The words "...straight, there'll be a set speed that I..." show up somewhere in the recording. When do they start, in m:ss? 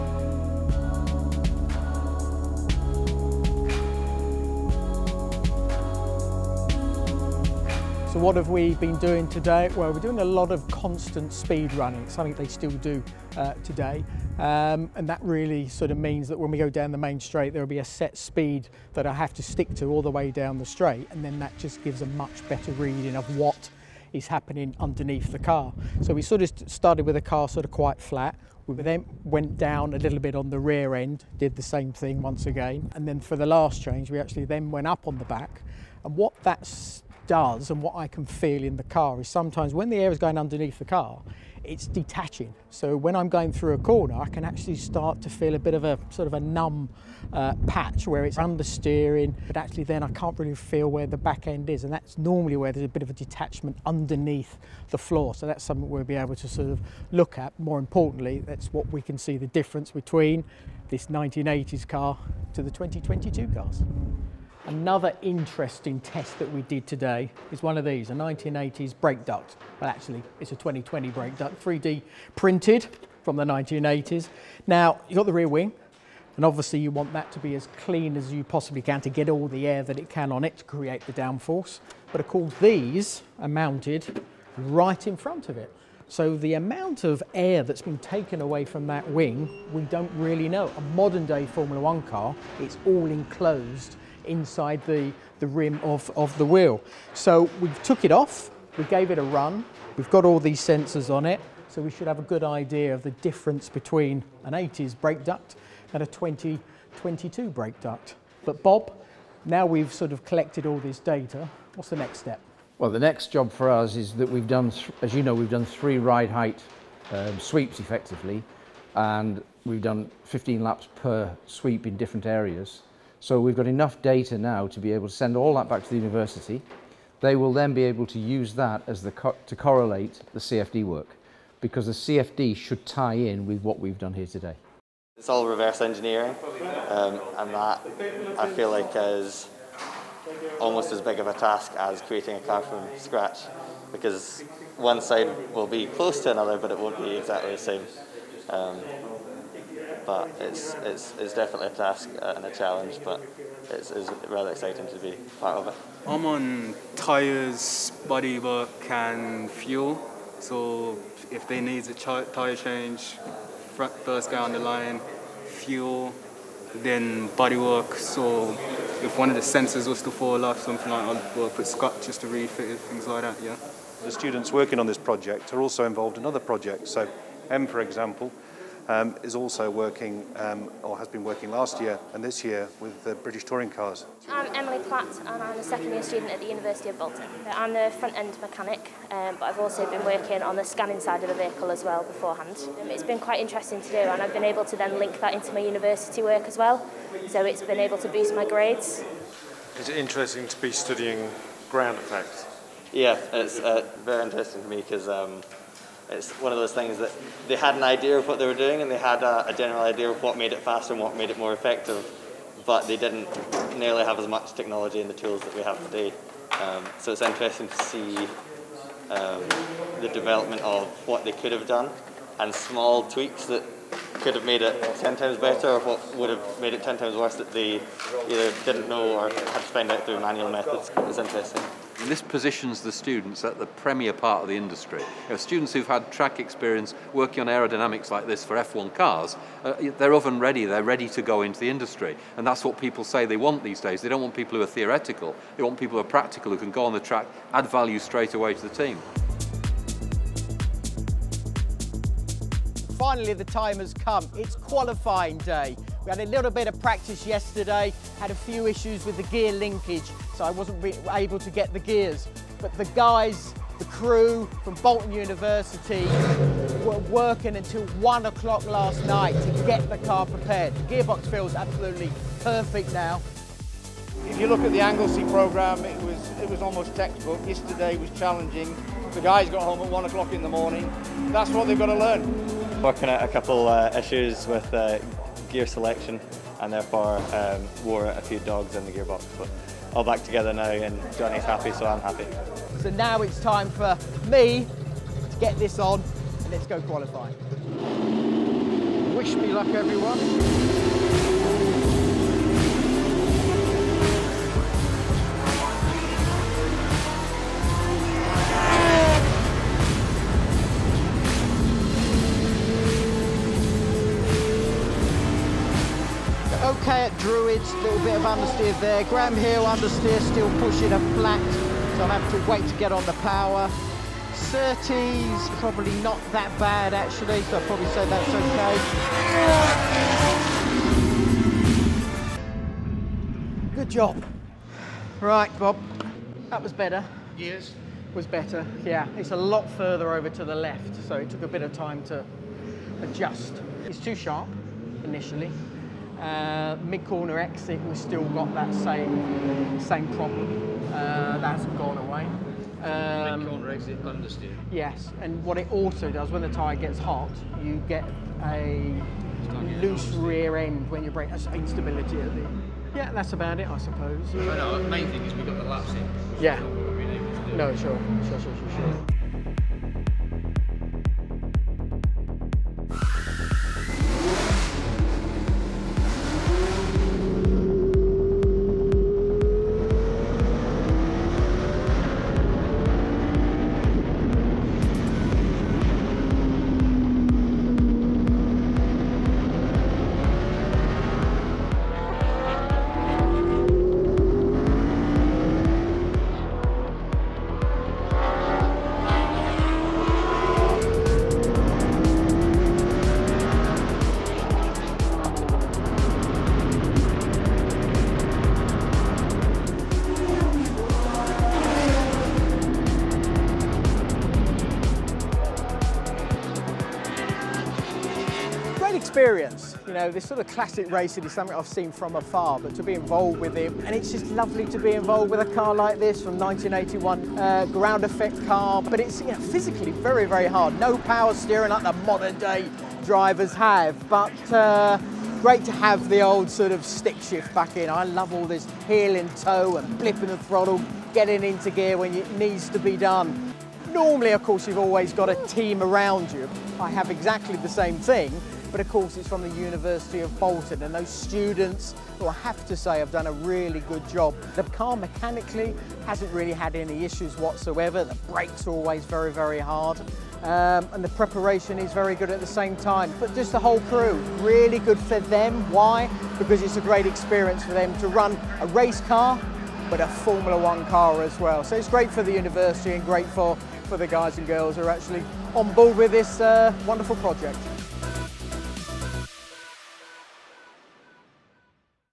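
0:17.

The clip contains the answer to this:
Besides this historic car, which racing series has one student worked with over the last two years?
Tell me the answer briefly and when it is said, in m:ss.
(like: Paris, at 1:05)
British touring cars, at 3:03.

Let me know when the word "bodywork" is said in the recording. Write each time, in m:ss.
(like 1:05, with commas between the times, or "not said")
2:38, 2:47.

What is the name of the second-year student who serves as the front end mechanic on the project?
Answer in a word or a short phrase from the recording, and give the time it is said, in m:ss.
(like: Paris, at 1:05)
Emily Platt, at 3:04.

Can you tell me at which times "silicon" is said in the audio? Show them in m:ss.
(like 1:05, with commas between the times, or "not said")
not said.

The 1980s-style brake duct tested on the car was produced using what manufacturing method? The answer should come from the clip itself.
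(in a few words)
3D printed.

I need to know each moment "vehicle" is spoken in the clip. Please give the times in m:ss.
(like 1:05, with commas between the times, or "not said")
3:11.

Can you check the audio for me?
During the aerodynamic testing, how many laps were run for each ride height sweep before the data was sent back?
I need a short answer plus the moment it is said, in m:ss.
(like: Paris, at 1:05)
15, at 2:00.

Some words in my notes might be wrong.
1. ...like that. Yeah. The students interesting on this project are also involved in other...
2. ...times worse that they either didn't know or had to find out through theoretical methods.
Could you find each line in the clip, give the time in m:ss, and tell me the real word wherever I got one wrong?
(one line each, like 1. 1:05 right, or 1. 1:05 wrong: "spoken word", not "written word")
1. 2:53 wrong: "working", not "interesting"
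2. 3:46 wrong: "manual", not "theoretical".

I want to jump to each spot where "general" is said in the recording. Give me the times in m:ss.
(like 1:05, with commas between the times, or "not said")
3:29.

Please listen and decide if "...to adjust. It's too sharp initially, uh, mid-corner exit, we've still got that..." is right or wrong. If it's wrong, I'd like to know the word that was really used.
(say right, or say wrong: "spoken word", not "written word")
right.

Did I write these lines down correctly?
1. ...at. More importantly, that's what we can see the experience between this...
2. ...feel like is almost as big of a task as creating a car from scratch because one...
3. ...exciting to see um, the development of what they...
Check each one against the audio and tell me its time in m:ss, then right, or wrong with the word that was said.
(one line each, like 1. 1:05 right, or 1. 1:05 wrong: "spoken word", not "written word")
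1. 0:57 wrong: "difference", not "experience"
2. 2:18 right
3. 3:37 wrong: "interesting", not "exciting".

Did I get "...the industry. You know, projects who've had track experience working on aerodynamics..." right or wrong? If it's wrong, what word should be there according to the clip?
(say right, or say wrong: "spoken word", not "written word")
wrong: "students", not "projects".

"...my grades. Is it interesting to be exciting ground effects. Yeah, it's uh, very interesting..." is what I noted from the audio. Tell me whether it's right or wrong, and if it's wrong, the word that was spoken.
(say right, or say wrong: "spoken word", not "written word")
wrong: "studying", not "exciting".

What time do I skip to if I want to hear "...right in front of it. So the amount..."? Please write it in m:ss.
1:24.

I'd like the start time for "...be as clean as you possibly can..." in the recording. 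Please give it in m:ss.
1:17.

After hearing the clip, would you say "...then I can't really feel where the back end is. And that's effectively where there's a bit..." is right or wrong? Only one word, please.
wrong.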